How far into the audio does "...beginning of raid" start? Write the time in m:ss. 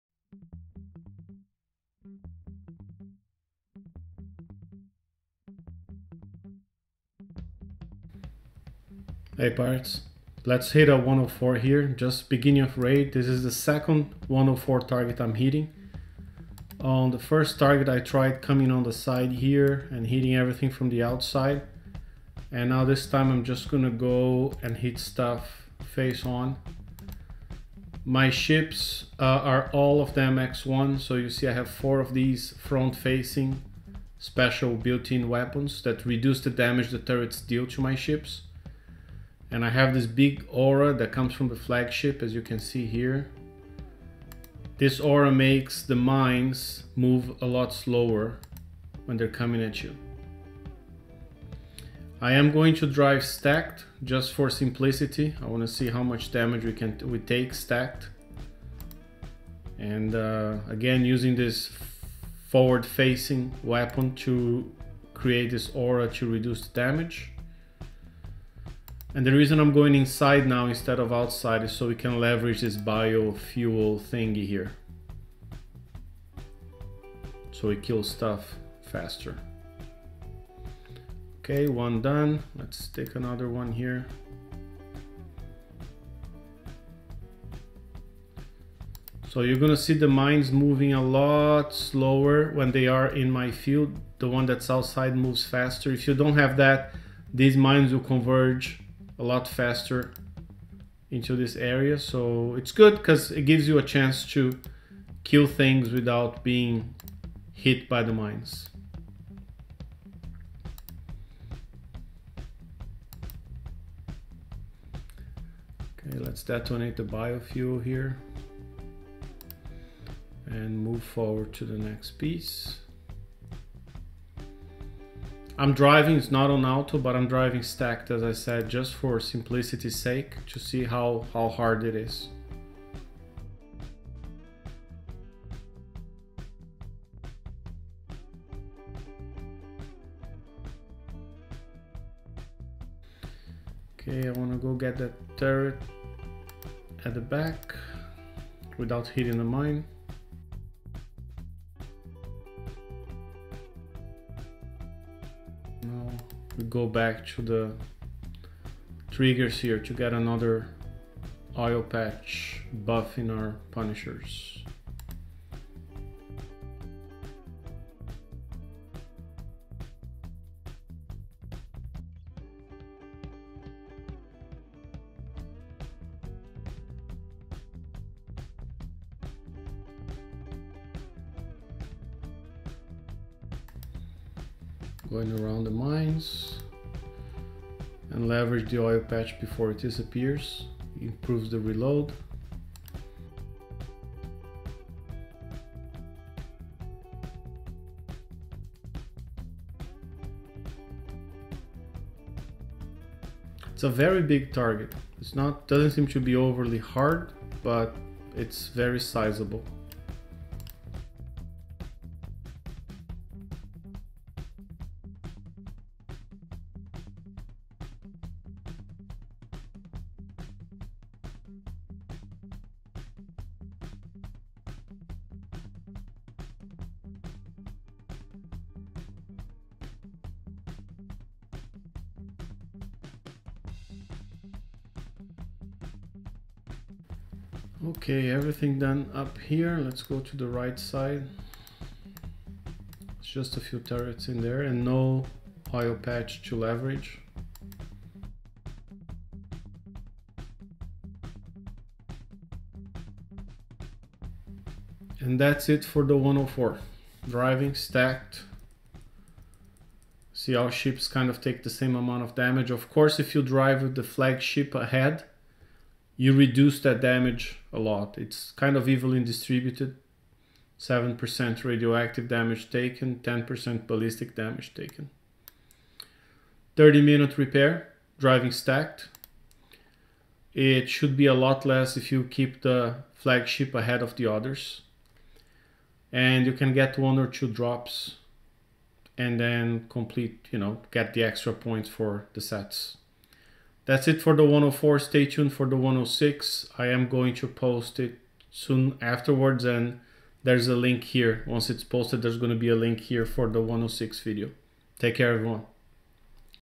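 0:12.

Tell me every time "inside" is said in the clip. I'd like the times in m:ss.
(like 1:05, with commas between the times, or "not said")
1:09.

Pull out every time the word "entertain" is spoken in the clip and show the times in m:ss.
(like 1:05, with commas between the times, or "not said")
not said.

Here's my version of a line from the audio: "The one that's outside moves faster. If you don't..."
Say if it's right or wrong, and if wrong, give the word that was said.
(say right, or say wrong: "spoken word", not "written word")
right.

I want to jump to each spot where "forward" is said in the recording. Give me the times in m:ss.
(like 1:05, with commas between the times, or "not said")
1:02, 2:01.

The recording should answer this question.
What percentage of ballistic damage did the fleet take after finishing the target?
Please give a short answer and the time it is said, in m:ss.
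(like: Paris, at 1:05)
10%, at 4:33.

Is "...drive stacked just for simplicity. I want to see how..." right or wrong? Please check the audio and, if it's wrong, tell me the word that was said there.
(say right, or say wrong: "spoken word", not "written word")
right.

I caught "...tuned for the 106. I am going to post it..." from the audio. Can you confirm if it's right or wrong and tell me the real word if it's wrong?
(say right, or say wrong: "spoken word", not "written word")
right.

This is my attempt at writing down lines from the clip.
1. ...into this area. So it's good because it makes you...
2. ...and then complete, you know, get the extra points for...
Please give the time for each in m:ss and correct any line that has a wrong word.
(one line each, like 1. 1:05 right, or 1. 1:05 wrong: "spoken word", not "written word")
1. 1:41 wrong: "gives", not "makes"
2. 4:49 right.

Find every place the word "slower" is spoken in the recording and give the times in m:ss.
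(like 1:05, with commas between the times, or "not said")
0:47, 1:31.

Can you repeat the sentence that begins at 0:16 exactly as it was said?
On the first target I tried coming on the side here and hitting everything from the outside.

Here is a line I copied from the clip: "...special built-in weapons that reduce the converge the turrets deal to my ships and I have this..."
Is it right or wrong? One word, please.
wrong.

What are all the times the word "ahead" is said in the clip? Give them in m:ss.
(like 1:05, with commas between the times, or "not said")
4:24, 4:43.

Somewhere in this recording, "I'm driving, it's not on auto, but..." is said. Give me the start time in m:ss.
2:05.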